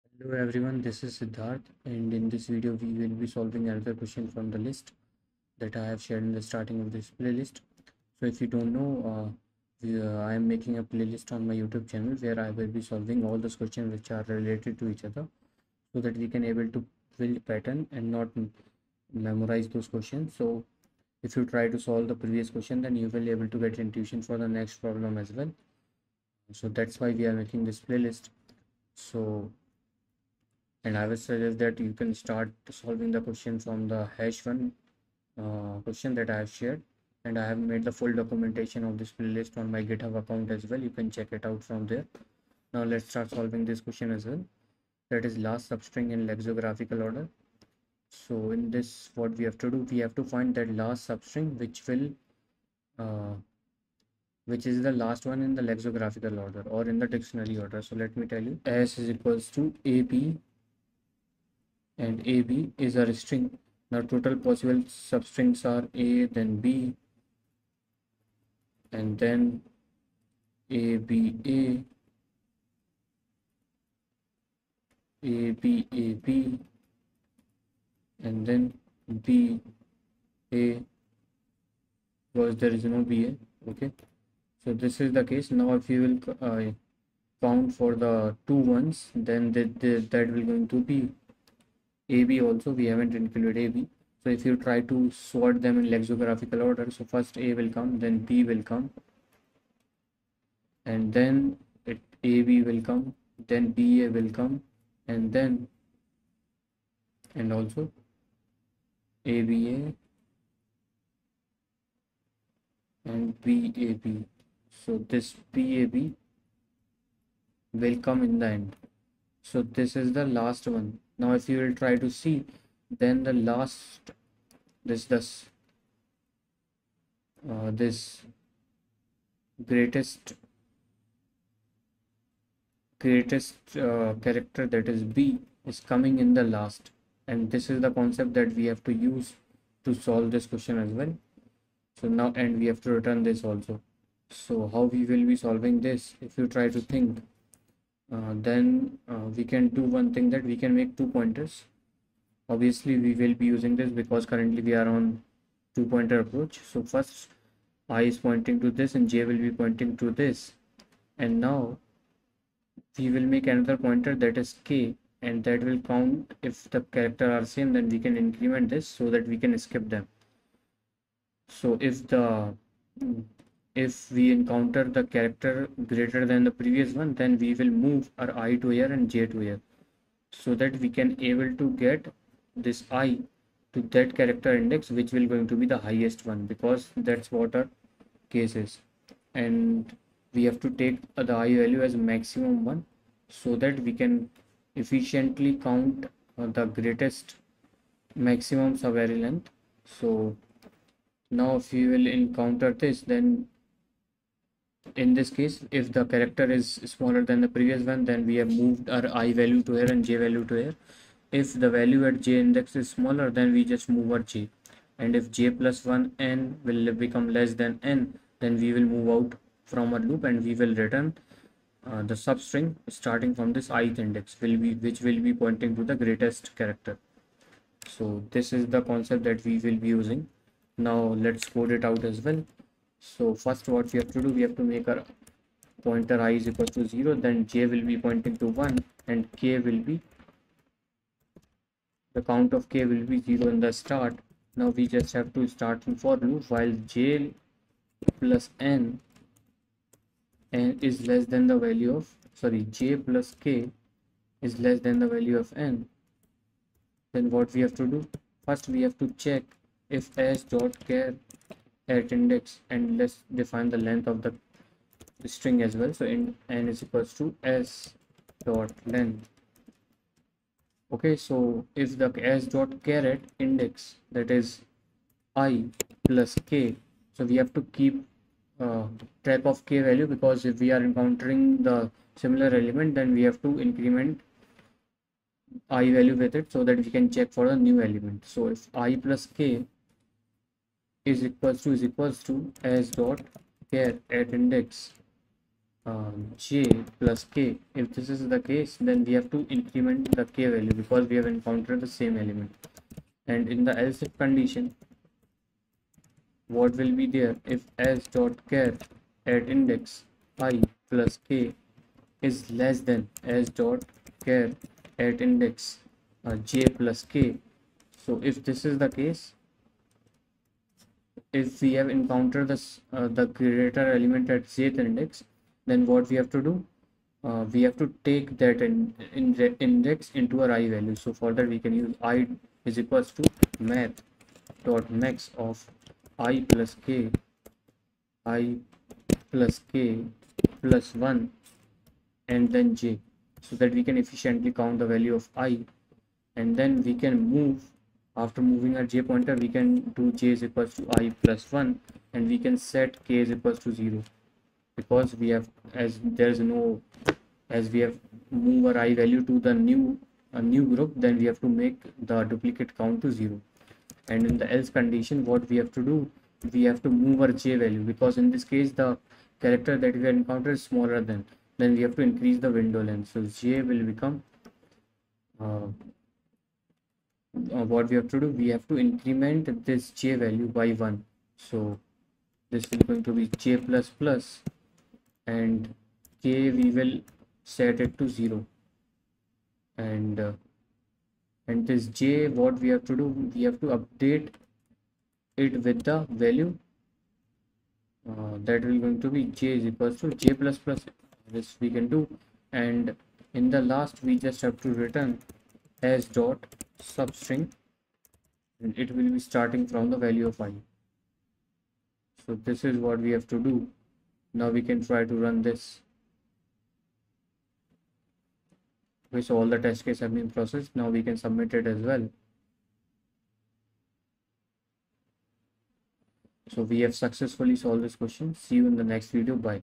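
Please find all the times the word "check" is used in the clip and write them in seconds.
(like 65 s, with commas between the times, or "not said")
41 s, 259 s, 287 s.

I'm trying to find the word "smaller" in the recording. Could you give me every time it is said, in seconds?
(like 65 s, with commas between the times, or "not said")
206 s, 212 s, 370 s.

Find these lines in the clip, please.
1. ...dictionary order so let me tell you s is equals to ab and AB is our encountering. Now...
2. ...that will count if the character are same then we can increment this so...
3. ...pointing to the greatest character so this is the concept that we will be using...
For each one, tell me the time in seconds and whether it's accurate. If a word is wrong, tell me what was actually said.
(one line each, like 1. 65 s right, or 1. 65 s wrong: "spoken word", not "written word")
1. 57 s wrong: "string", not "encountering"
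2. 165 s right
3. 225 s right.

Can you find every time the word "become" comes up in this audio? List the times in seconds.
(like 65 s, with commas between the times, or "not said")
216 s, 373 s.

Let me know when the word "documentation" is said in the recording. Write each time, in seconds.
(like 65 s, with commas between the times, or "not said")
38 s.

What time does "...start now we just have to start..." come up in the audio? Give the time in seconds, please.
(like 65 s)
243 s.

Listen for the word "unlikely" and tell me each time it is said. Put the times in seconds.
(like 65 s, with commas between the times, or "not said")
not said.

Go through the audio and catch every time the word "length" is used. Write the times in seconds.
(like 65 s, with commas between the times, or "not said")
198 s, 263 s, 268 s, 372 s.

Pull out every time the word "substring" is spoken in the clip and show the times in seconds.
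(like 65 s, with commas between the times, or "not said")
45 s, 51 s, 64 s, 222 s, 406 s.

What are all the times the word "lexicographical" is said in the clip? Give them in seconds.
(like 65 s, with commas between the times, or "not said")
46 s, 55 s, 95 s.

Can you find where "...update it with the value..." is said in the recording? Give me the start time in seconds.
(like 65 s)
393 s.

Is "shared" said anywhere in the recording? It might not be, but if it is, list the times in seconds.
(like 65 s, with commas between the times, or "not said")
5 s, 36 s.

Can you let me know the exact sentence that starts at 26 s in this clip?
So that's why we are making this playlist.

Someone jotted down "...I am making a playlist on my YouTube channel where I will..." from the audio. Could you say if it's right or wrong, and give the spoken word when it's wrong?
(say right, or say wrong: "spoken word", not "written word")
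right.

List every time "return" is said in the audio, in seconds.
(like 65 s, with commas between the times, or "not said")
142 s, 220 s, 404 s.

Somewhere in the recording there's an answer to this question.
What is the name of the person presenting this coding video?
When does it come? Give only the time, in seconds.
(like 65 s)
1 s.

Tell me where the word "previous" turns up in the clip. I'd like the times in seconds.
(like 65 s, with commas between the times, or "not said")
22 s, 176 s, 207 s.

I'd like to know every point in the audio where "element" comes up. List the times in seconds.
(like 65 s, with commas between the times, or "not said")
282 s, 287 s, 302 s, 323 s.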